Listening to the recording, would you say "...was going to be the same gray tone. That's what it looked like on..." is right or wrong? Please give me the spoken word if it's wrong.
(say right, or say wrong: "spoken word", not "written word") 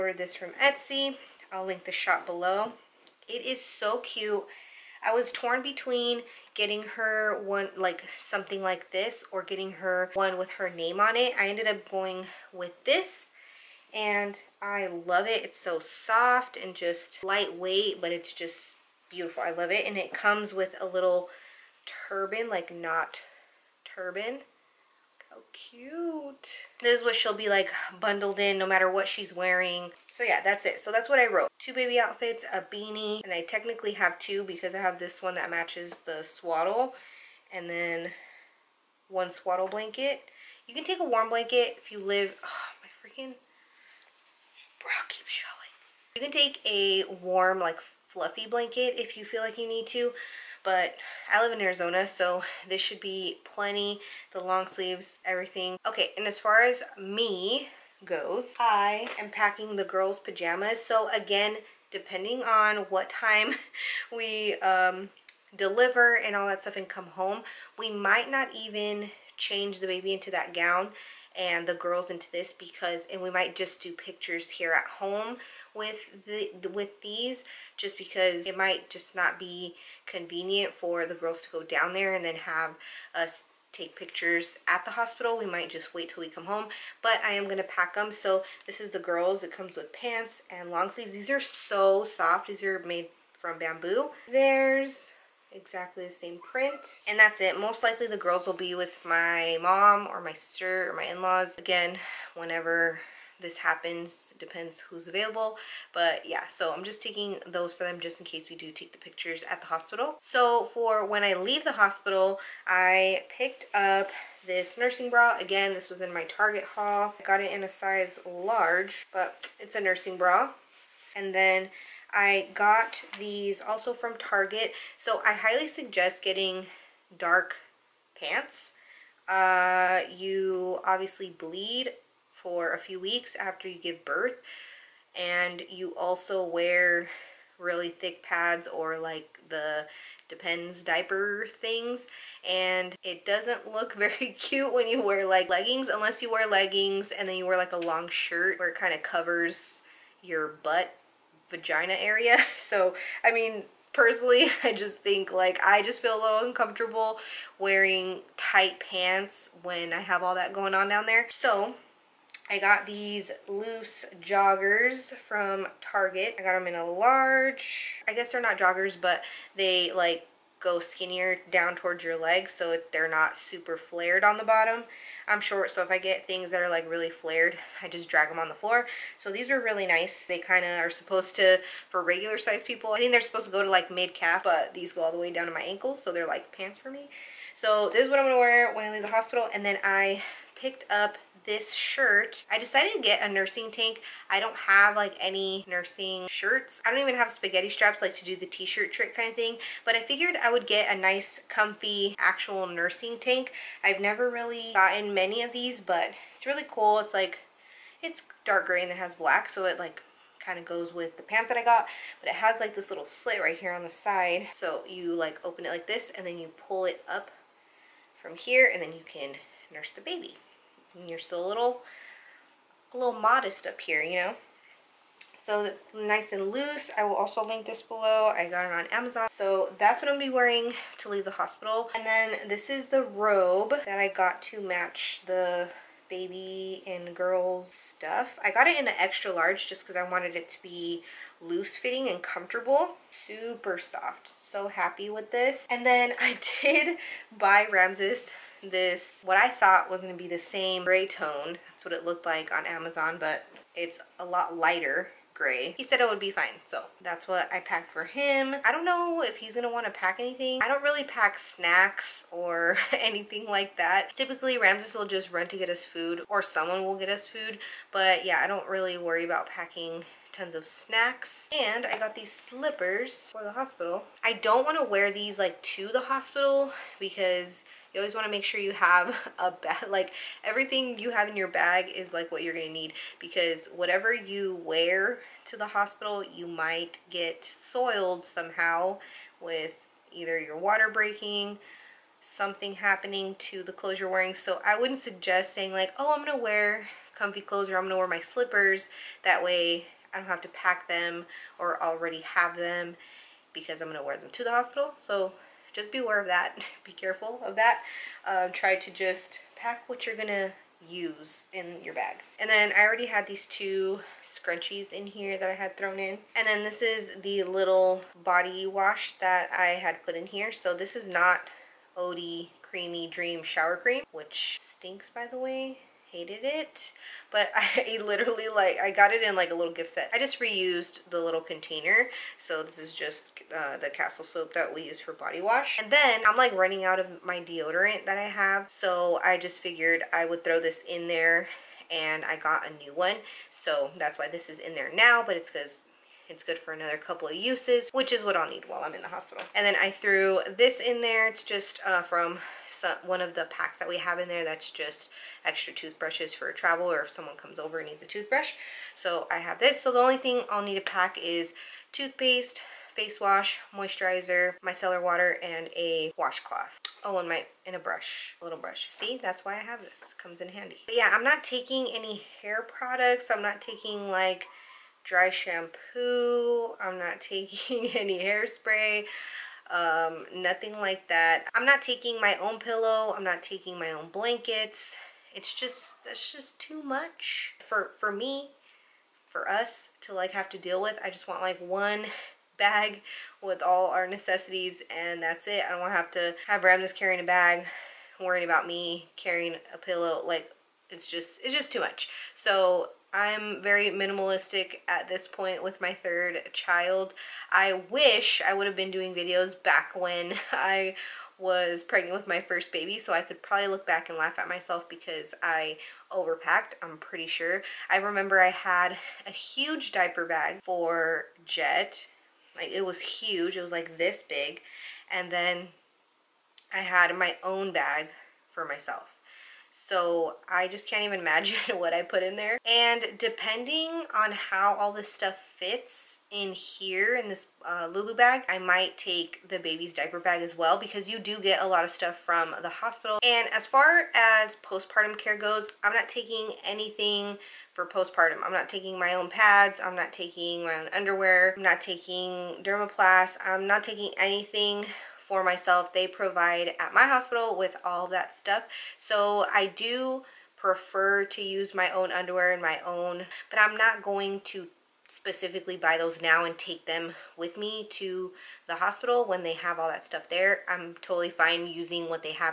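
right.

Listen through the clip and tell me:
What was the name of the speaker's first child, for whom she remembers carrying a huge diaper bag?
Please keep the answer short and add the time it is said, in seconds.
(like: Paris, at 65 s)
Jet, at 421 s.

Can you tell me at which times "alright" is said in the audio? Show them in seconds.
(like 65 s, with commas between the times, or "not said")
not said.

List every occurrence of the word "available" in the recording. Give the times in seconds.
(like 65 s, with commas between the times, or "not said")
105 s.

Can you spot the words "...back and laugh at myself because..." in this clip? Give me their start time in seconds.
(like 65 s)
413 s.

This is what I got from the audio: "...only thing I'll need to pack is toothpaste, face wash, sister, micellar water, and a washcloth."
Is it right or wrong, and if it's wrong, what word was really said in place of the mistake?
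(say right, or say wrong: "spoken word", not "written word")
wrong: "moisturizer", not "sister".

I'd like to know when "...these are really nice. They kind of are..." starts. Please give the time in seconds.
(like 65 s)
179 s.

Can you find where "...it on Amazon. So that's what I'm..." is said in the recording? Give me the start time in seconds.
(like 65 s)
228 s.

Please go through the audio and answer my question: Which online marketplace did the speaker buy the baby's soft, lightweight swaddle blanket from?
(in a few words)
Etsy.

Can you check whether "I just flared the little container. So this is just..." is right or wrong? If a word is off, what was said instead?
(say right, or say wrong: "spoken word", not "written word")
wrong: "reused", not "flared".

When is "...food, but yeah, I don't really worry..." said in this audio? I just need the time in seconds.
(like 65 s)
267 s.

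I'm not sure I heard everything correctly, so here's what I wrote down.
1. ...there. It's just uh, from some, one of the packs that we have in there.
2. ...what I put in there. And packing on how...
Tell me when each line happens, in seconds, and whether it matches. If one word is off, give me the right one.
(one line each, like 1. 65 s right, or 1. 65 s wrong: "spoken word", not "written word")
1. 351 s right
2. 431 s wrong: "depending", not "packing".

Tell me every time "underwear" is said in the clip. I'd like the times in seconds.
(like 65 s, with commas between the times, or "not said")
450 s, 462 s.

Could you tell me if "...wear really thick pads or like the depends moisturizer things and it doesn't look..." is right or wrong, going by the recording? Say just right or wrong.
wrong.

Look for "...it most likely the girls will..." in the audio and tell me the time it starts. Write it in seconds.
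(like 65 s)
97 s.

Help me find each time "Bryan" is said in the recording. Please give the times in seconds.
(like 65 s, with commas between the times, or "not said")
not said.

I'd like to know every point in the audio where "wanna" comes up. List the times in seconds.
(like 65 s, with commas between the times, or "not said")
259 s.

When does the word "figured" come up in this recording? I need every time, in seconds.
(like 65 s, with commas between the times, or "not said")
200 s, 339 s.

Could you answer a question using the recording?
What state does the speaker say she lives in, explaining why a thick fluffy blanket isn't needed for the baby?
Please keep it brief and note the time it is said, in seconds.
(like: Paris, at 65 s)
Arizona, at 51 s.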